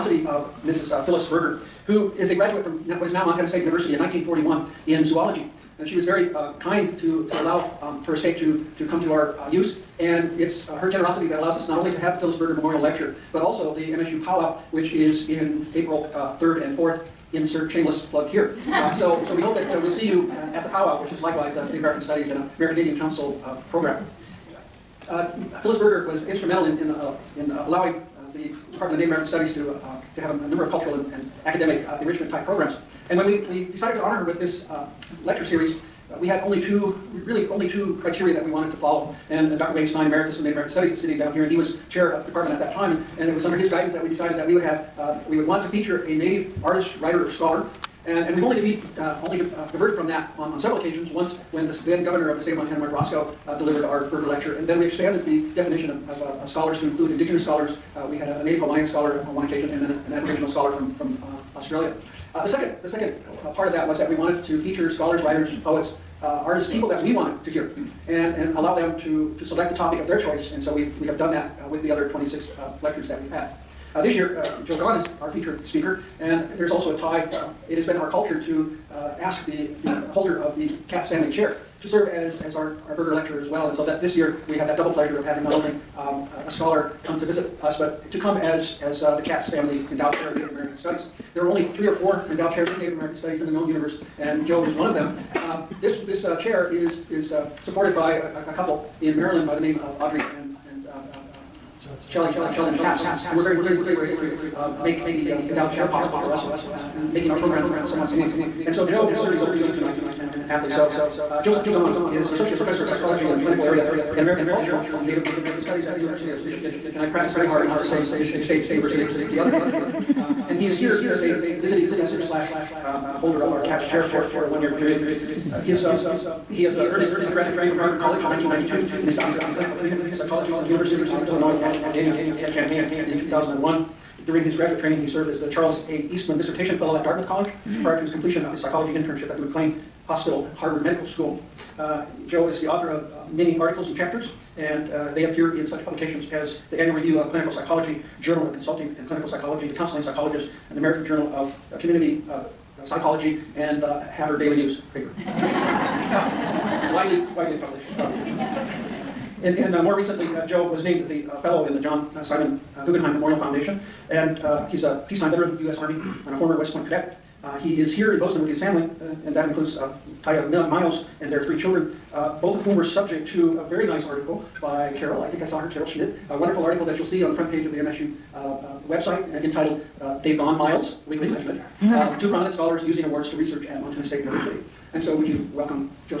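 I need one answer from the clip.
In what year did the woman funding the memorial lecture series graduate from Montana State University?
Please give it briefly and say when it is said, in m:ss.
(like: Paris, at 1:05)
1941, at 0:03.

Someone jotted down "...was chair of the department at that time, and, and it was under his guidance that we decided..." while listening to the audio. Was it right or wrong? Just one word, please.
right.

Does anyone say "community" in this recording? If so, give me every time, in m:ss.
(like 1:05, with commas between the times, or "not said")
2:09, 2:31.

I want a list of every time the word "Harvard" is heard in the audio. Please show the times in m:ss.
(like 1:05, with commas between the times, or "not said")
2:07, 2:20.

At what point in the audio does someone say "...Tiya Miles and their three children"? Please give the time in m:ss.
2:50.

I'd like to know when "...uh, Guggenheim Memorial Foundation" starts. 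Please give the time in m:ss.
2:42.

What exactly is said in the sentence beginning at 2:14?
During his graduate training, he served as the Charles A.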